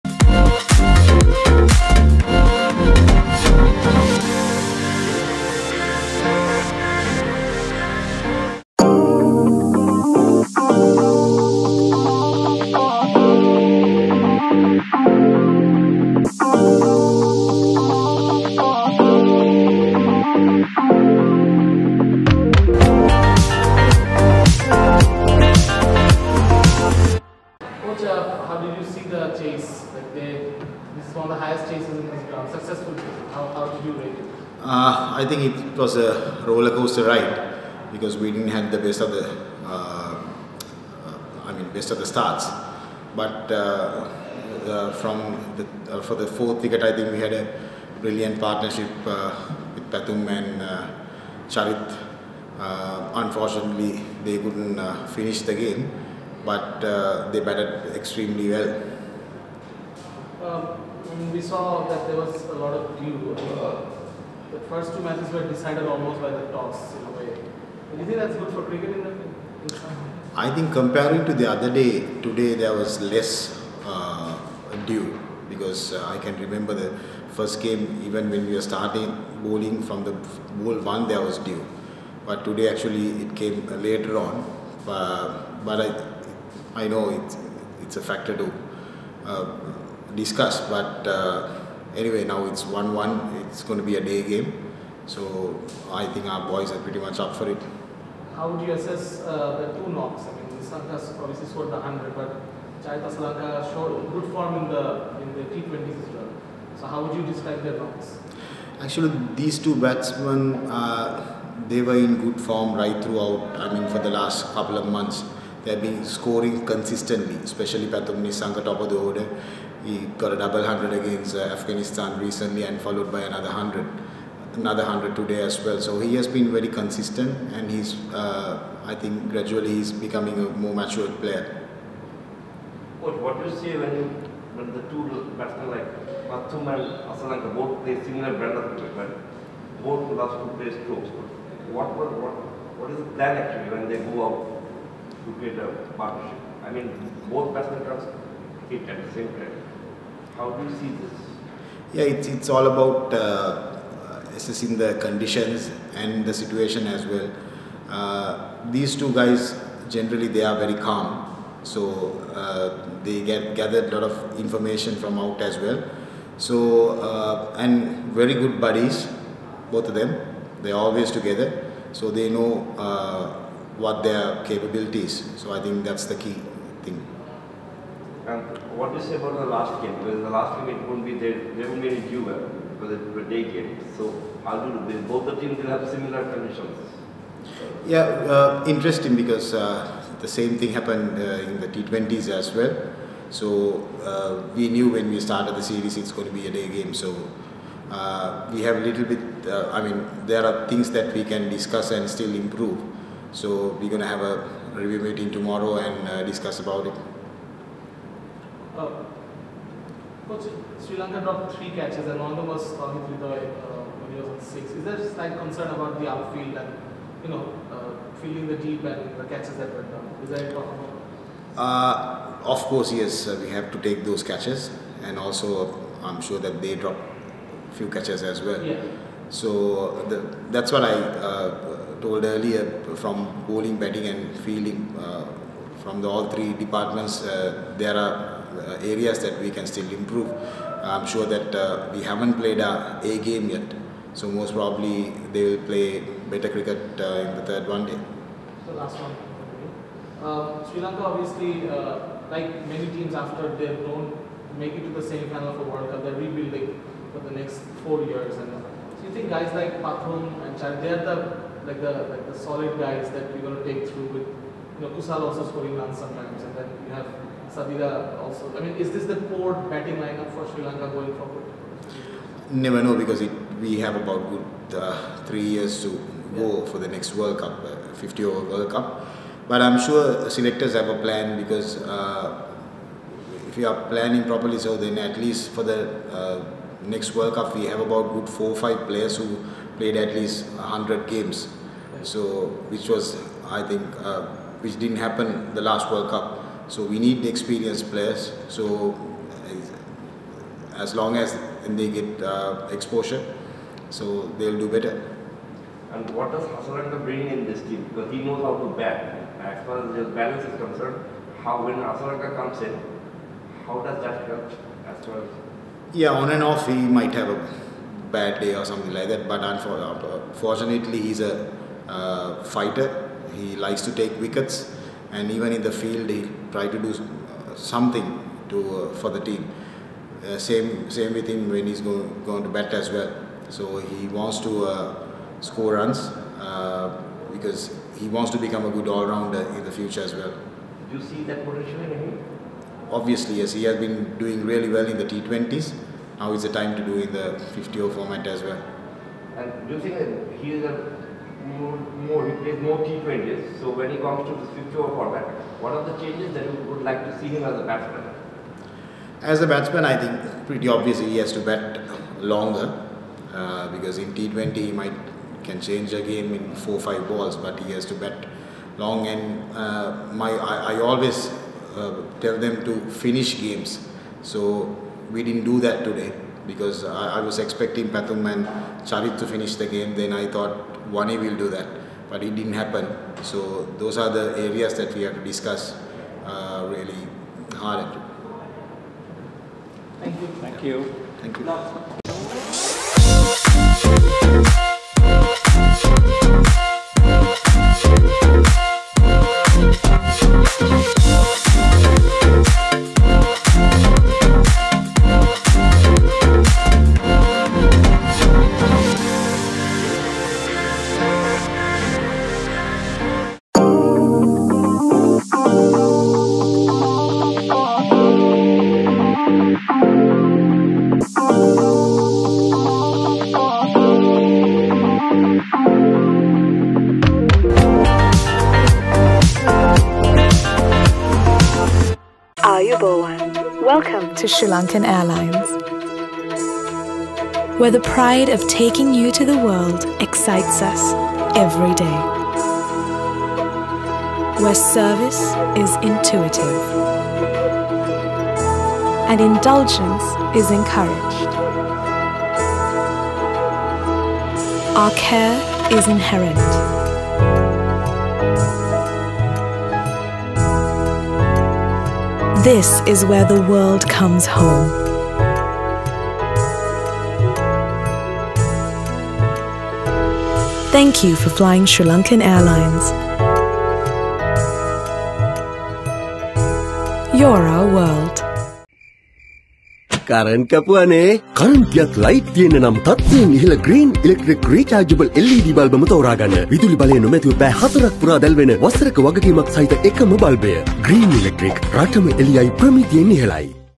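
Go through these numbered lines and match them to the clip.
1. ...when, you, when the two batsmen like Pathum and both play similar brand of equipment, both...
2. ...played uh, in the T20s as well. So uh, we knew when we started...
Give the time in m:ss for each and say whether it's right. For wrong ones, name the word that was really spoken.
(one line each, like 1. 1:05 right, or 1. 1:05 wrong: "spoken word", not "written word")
1. 2:13 right
2. 3:10 wrong: "happened", not "played".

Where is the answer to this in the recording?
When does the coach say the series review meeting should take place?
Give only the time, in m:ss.
3:25.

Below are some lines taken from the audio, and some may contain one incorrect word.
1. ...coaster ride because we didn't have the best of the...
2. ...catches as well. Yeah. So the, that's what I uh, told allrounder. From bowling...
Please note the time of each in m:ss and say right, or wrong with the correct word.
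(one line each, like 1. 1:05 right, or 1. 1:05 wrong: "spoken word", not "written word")
1. 0:36 right
2. 3:47 wrong: "earlier", not "allrounder".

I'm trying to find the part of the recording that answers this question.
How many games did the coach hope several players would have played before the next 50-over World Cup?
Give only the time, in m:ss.
4:50.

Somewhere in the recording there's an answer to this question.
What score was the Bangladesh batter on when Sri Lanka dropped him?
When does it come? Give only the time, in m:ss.
3:34.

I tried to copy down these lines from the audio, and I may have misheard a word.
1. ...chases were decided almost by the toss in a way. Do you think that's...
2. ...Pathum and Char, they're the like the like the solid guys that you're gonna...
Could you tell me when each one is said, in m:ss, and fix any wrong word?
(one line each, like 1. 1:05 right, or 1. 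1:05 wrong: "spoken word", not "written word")
1. 1:05 wrong: "matches", not "chases"
2. 4:19 right.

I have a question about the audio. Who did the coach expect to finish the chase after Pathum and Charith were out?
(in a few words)
Wani.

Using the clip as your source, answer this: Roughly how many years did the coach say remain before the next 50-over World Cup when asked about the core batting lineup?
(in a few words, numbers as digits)
3.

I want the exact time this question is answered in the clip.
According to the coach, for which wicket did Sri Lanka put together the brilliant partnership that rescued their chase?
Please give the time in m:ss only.
0:46.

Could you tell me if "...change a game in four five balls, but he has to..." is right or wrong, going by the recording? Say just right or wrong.
right.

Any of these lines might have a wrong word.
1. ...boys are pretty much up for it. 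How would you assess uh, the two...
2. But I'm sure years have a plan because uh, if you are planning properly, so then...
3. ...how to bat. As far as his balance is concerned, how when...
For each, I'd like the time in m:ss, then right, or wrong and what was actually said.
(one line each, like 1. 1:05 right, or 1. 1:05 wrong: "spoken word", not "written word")
1. 1:36 right
2. 4:39 wrong: "selectors", not "years"
3. 5:08 right.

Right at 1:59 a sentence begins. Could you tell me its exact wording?
He got a double hundred against Afghanistan recently and followed by another hundred, another hundred today as well.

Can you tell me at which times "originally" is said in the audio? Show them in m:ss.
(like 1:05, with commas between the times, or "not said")
not said.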